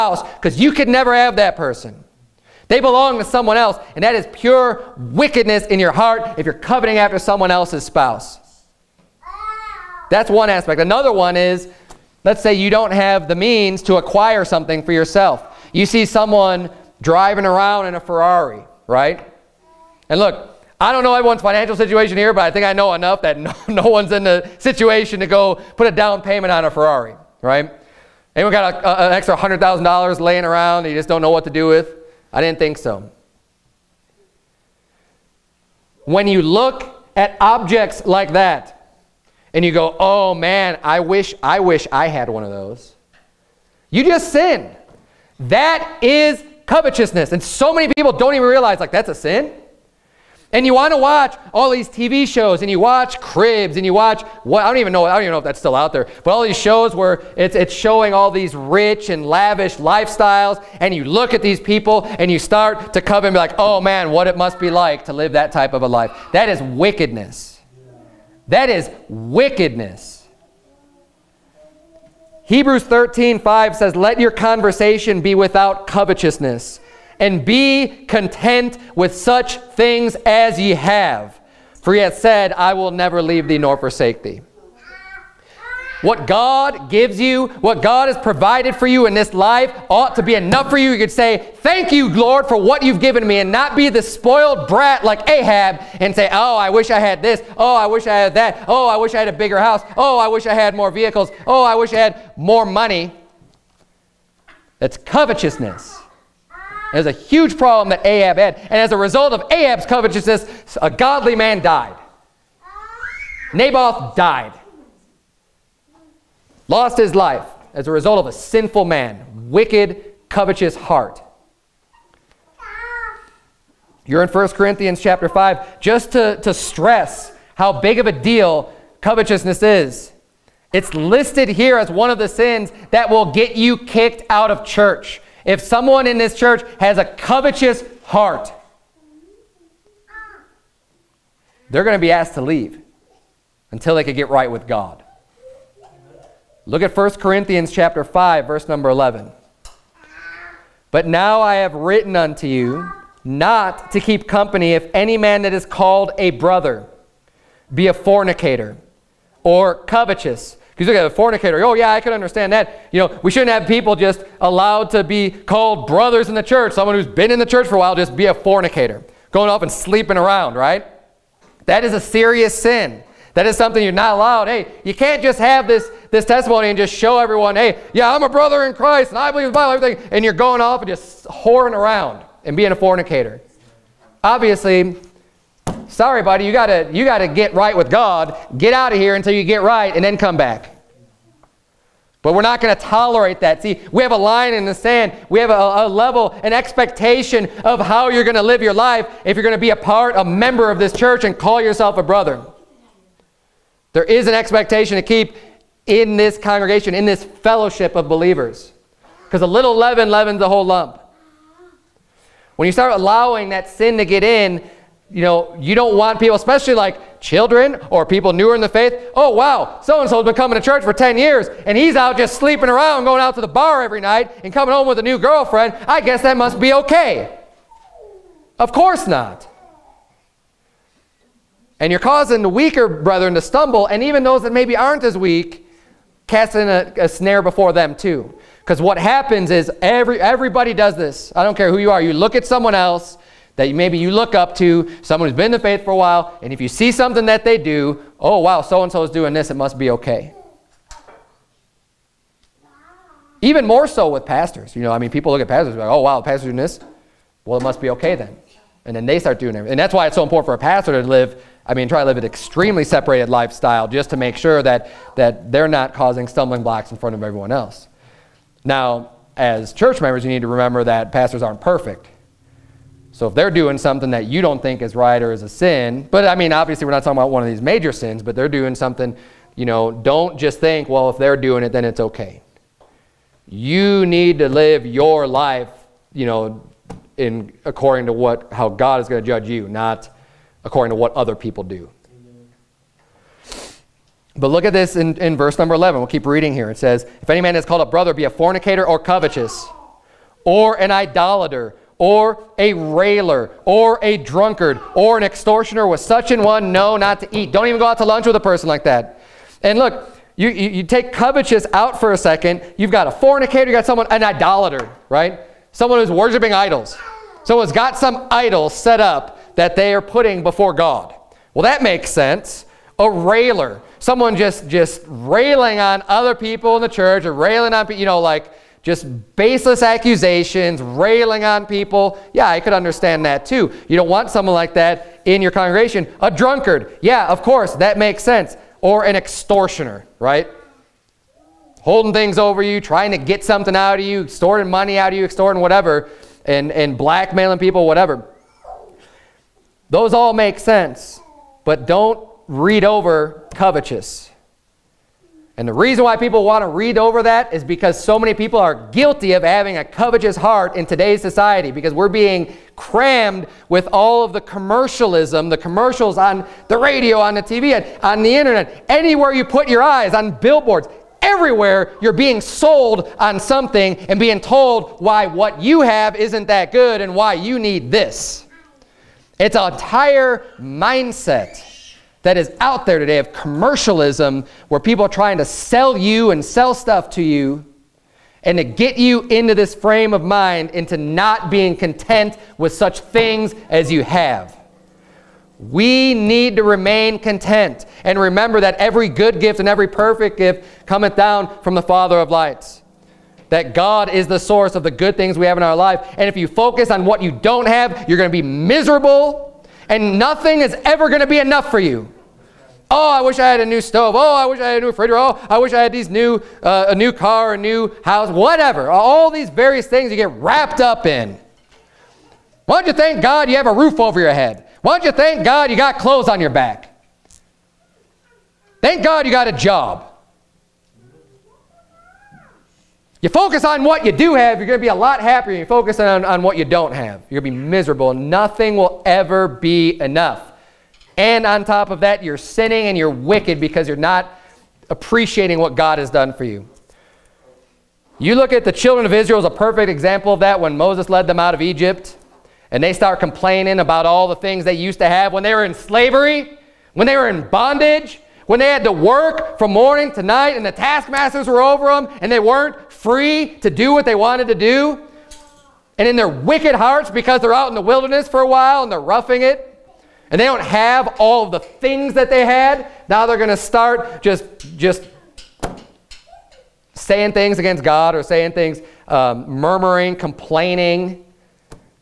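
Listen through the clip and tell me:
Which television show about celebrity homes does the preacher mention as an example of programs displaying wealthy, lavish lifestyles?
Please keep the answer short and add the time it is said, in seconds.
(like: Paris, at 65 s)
Cribs, at 53 s.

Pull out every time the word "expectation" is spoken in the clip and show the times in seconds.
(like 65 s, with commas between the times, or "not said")
196 s, 204 s.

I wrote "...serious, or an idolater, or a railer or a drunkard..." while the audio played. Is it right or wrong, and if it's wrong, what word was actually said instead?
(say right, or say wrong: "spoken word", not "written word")
wrong: "covetous", not "serious".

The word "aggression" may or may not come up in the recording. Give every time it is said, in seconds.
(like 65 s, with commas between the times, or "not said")
not said.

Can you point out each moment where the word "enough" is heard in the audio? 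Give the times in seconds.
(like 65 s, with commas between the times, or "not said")
22 s, 90 s, 411 s, 440 s.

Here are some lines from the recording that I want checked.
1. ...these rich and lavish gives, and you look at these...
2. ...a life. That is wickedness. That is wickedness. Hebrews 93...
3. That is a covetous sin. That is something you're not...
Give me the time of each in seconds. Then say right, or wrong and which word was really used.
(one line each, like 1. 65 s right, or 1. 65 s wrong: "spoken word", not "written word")
1. 58 s wrong: "lifestyles", not "gives"
2. 65 s wrong: "13", not "93"
3. 171 s wrong: "serious", not "covetous".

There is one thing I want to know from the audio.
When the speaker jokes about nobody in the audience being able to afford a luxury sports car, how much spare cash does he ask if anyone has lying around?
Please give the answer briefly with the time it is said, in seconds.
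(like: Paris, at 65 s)
$100,000, at 29 s.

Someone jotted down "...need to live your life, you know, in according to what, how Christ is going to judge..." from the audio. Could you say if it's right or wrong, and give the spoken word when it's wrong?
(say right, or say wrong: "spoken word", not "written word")
wrong: "God", not "Christ".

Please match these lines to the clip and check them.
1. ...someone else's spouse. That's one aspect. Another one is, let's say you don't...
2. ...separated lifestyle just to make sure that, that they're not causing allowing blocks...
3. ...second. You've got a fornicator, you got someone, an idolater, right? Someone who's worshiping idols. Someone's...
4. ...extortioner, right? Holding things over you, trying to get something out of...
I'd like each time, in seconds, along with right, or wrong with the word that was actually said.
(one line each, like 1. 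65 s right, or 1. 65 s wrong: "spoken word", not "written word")
1. 7 s right
2. 262 s wrong: "stumbling", not "allowing"
3. 312 s right
4. 339 s right.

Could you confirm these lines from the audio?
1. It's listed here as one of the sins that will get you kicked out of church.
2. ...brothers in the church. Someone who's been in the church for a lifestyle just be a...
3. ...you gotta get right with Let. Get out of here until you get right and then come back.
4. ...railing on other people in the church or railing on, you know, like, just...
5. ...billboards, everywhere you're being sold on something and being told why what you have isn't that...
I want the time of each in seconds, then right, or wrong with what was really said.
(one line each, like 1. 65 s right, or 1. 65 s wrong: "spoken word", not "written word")
1. 130 s right
2. 165 s wrong: "while", not "lifestyle"
3. 186 s wrong: "God", not "Let"
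4. 325 s right
5. 370 s right.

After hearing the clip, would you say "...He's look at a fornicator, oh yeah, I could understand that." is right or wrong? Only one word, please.
right.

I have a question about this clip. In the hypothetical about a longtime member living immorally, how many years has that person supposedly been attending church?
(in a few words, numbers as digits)
10 years.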